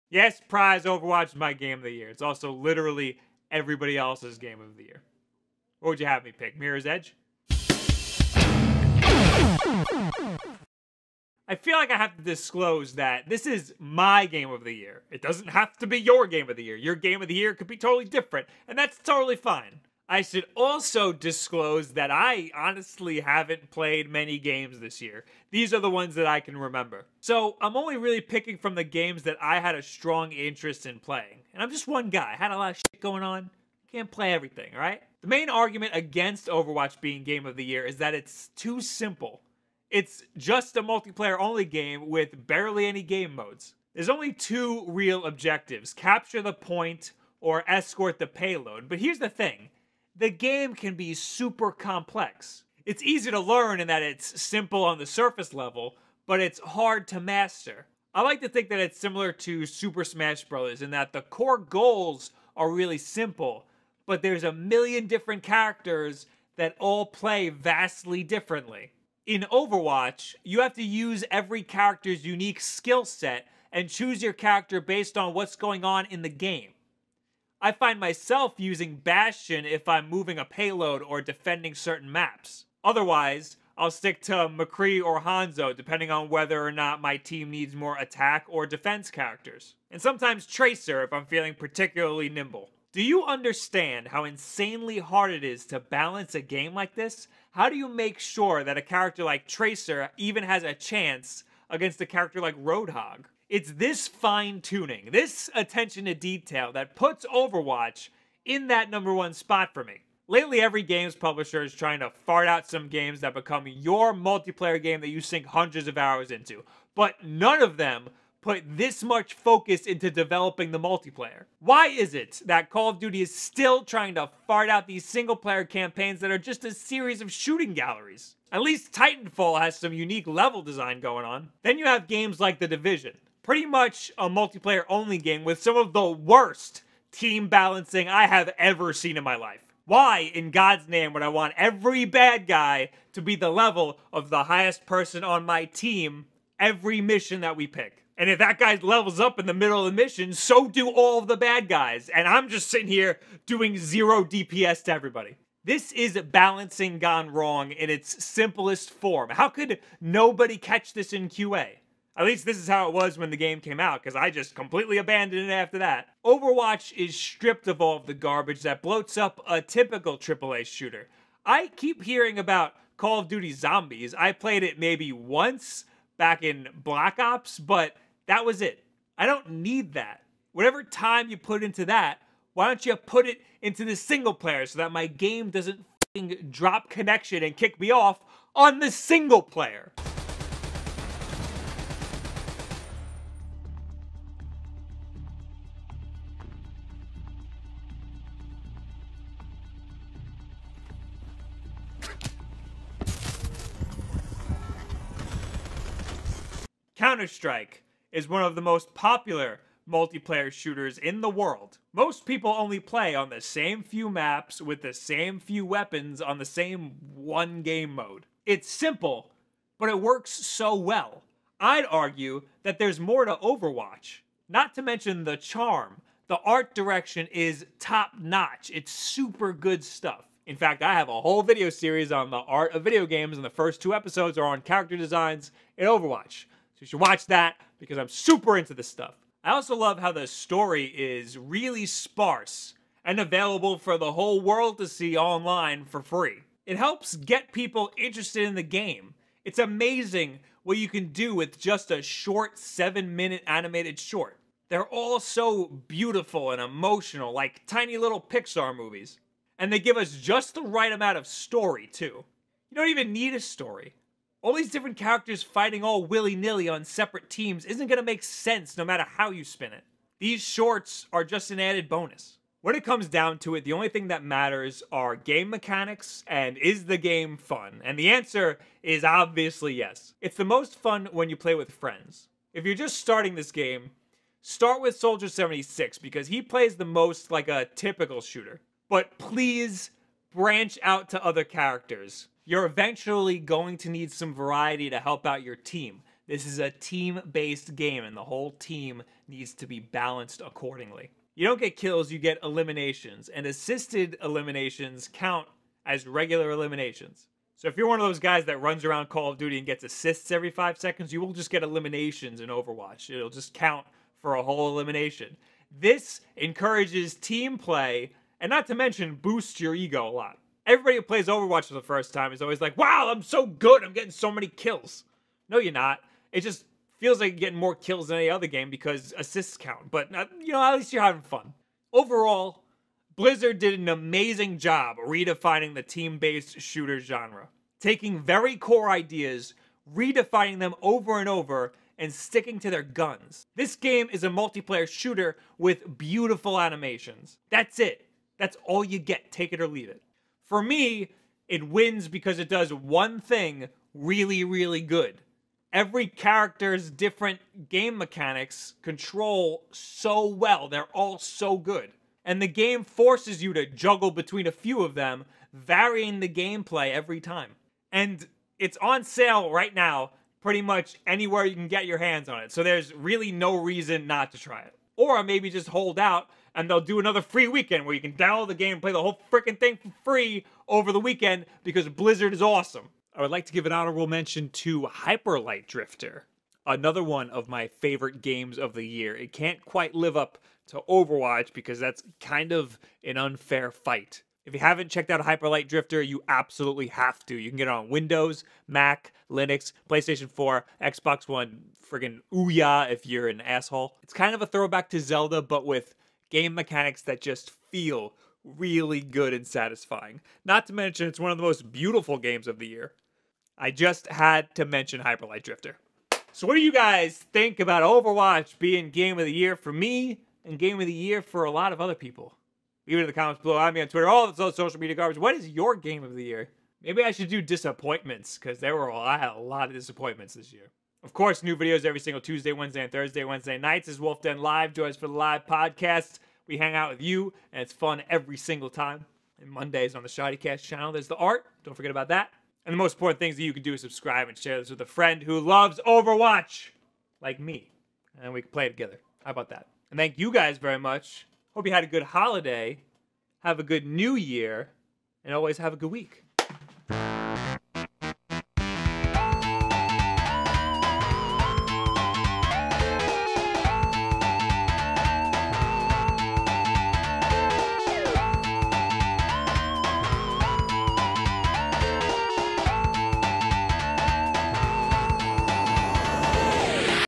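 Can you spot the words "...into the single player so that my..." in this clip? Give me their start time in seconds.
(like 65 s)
183 s.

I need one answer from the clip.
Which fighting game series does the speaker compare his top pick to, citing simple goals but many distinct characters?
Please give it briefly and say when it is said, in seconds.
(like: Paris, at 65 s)
Super Smash Bros., at 59 s.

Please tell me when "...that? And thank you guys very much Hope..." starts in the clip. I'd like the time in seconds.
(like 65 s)
449 s.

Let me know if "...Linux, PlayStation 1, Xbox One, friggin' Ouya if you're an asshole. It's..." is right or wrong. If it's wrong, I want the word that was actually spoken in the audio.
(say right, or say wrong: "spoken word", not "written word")
wrong: "4", not "1".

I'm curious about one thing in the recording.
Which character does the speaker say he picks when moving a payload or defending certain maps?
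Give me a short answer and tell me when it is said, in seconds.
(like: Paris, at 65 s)
Bastion, at 78 s.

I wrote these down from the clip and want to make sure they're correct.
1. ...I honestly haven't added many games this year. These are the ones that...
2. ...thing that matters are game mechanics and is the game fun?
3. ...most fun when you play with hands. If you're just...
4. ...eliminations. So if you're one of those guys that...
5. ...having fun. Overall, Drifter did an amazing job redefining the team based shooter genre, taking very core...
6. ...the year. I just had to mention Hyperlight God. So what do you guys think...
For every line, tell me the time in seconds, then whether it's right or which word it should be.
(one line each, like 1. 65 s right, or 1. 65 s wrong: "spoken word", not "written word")
1. 22 s wrong: "played", not "added"
2. 273 s right
3. 280 s wrong: "friends", not "hands"
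4. 306 s right
5. 331 s wrong: "Blizzard", not "Drifter"
6. 412 s wrong: "Drifter", not "God".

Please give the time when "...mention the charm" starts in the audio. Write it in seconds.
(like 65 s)
224 s.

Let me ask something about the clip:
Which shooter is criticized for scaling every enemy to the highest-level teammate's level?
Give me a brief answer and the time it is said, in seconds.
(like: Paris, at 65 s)
The Division, at 132 s.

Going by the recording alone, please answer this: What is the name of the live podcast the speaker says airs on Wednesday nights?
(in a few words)
Wulff Den Live.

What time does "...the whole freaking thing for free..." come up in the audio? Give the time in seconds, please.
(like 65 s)
378 s.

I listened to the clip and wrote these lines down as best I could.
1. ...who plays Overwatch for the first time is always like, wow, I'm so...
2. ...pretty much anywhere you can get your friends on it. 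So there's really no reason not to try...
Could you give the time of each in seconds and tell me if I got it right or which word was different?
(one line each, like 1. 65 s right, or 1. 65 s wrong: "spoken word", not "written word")
1. 320 s right
2. 370 s wrong: "hands", not "friends".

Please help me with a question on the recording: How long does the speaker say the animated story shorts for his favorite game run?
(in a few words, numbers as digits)
7 minutes.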